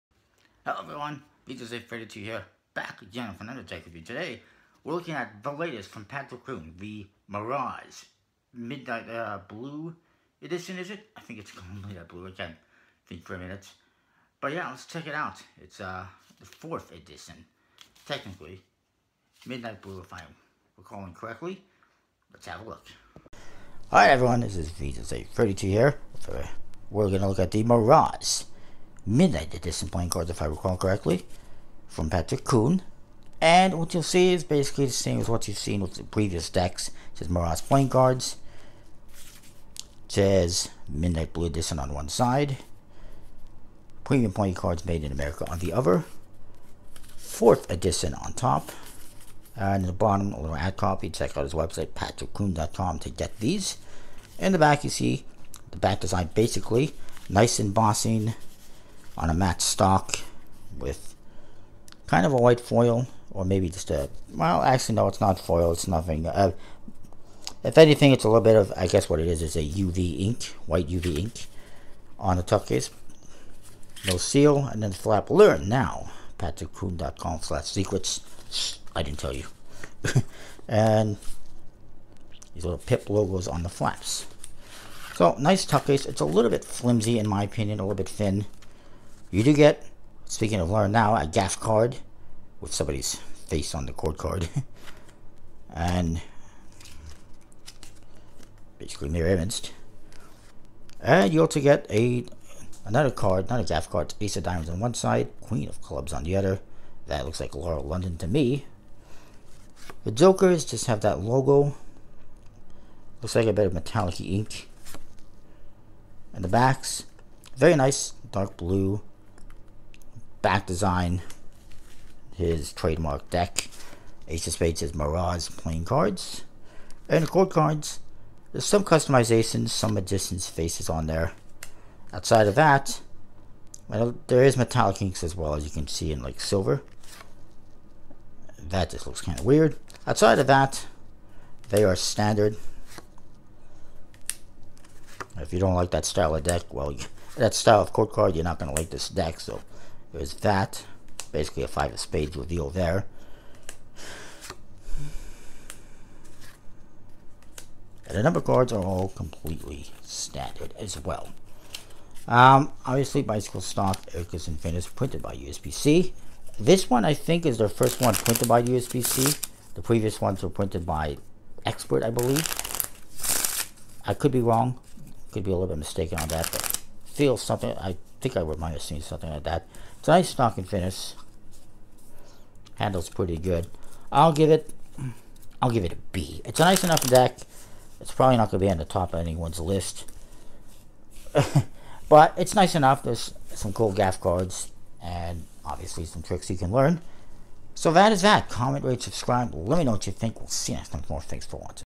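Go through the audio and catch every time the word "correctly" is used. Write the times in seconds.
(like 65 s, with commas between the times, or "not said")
21 s, 30 s.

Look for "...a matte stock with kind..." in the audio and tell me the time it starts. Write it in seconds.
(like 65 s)
59 s.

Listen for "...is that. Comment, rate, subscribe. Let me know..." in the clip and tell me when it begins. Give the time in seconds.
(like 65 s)
198 s.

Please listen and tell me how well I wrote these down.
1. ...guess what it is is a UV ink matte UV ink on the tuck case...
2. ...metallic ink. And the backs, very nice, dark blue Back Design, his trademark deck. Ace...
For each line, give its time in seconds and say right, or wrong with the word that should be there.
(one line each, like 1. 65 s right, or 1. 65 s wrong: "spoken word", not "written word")
1. 68 s wrong: "white", not "matte"
2. 113 s right.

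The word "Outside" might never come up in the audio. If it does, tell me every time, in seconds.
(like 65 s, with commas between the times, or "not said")
132 s, 140 s.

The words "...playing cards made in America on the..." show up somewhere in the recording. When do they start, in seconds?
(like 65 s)
44 s.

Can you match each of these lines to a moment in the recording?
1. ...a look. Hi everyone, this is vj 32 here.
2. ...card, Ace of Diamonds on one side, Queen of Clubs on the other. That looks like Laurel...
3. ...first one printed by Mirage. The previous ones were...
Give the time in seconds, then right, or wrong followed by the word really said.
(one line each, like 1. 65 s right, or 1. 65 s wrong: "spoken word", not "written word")
1. 22 s right
2. 103 s right
3. 167 s wrong: "USPCC", not "Mirage".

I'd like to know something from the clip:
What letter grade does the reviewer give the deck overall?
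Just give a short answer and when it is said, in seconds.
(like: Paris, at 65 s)
B, at 186 s.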